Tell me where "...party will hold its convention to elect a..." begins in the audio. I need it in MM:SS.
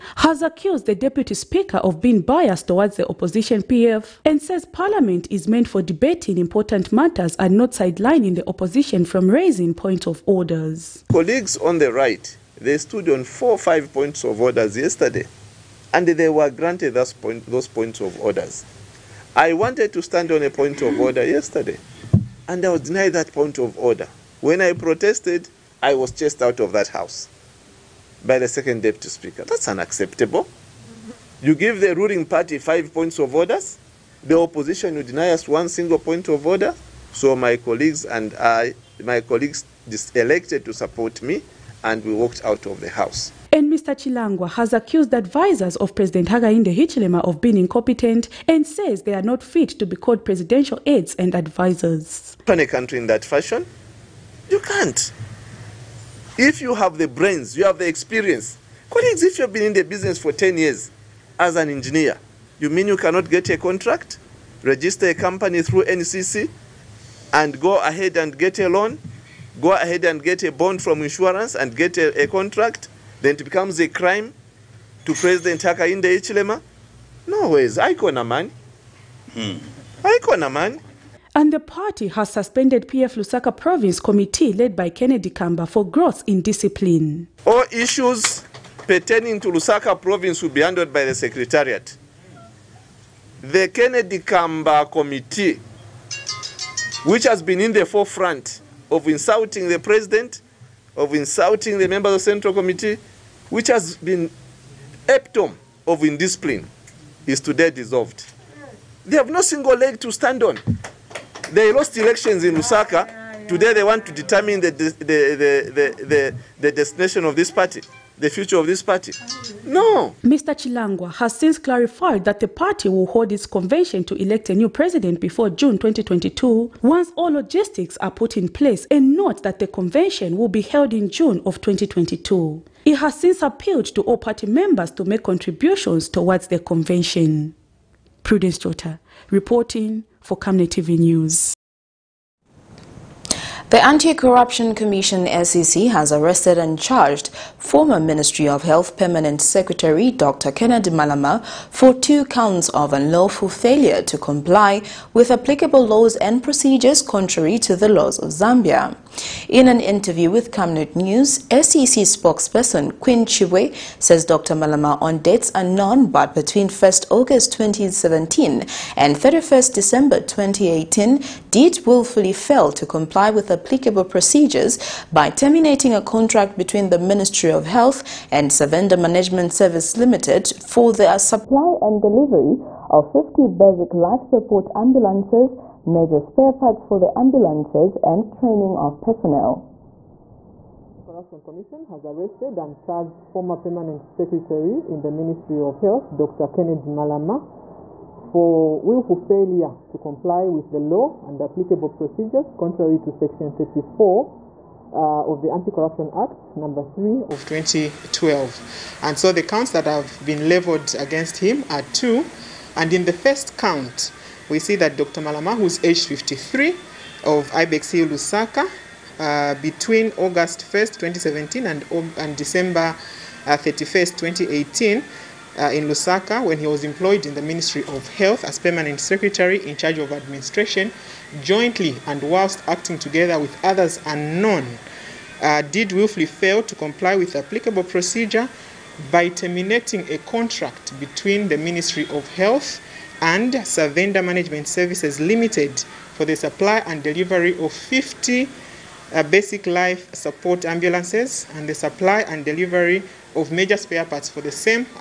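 02:02.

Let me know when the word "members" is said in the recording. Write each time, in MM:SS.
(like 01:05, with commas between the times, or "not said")
01:41, 02:14.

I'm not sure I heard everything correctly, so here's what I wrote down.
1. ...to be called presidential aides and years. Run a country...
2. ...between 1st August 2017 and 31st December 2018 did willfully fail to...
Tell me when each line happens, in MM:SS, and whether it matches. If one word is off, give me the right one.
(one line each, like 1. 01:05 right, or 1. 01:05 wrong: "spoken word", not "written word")
1. 00:49 wrong: "advisers", not "years"
2. 02:46 right.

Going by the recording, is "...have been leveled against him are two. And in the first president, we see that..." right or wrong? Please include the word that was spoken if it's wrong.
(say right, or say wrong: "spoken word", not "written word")
wrong: "count", not "president".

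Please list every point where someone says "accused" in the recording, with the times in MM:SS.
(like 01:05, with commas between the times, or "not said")
00:00, 00:44.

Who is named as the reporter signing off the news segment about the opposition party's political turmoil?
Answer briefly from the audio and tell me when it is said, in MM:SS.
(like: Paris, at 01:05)
Prudence Jota, at 02:18.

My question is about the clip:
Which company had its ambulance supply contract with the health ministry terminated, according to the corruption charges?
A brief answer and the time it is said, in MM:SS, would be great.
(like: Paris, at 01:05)
Savenda Management Service Limited, at 02:58.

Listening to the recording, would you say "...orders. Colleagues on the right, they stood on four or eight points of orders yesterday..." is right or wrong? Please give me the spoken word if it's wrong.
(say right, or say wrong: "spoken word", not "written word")
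wrong: "five", not "eight".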